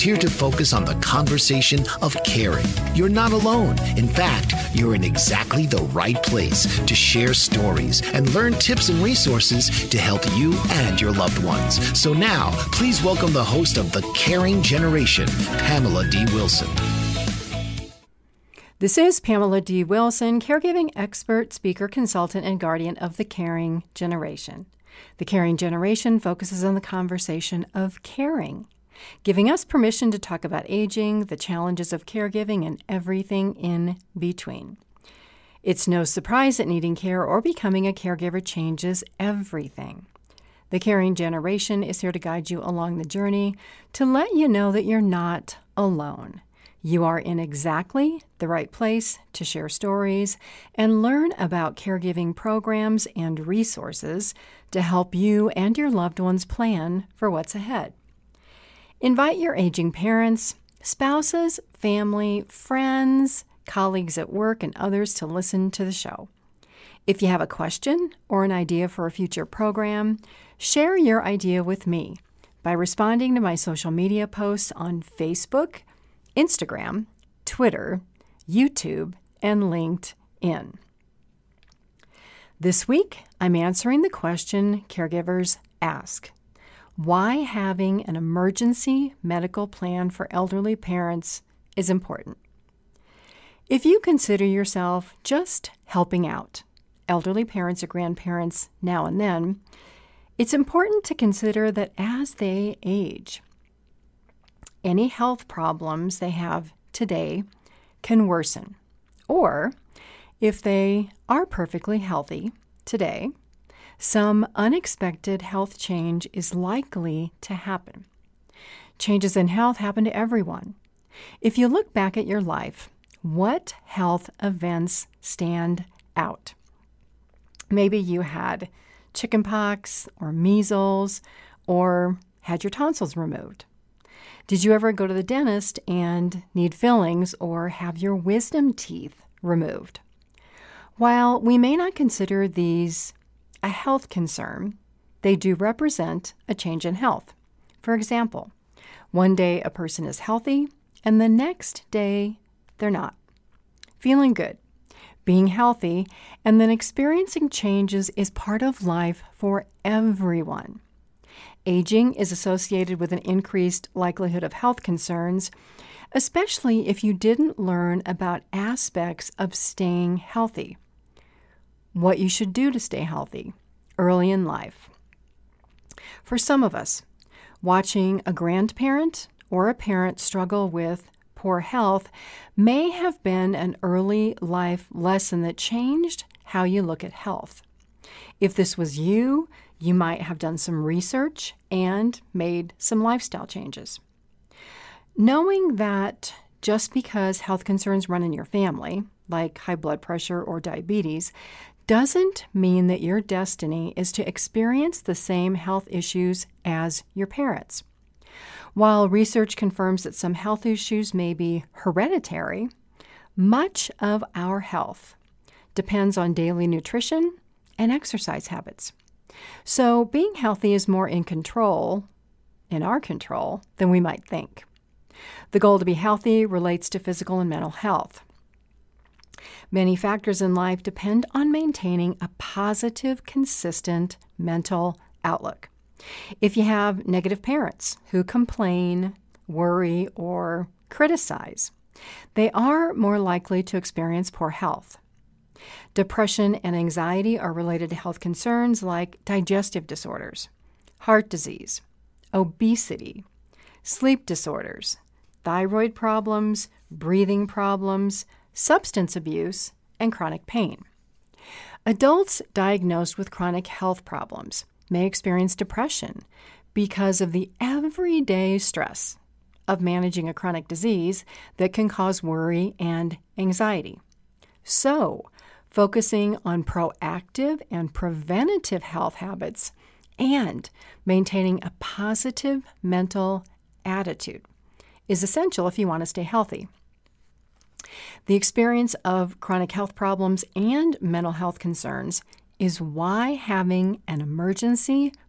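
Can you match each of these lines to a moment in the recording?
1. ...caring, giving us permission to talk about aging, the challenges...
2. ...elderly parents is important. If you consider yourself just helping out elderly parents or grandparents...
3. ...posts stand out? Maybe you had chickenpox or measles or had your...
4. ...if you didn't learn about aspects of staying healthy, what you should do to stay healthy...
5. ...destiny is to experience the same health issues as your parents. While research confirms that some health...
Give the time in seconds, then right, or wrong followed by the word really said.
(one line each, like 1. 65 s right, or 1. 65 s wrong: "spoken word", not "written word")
1. 28 s right
2. 90 s right
3. 124 s wrong: "events", not "posts"
4. 166 s right
5. 203 s right.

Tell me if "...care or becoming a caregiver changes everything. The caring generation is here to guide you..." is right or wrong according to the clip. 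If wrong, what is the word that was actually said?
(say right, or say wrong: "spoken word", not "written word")
right.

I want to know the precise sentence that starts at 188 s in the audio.
If this was you, you might have done some research and made some lifestyle changes.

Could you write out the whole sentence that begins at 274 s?
So, focusing on proactive and preventative health habits, and maintaining a positive mental attitude is essential if you want to stay healthy.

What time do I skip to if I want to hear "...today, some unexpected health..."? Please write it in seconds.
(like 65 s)
112 s.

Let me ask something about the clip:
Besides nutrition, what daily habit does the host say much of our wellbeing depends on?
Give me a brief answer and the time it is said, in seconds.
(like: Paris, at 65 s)
Exercise, at 217 s.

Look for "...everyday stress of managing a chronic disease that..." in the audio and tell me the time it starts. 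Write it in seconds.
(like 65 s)
267 s.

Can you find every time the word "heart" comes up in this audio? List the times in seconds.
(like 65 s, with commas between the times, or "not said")
250 s.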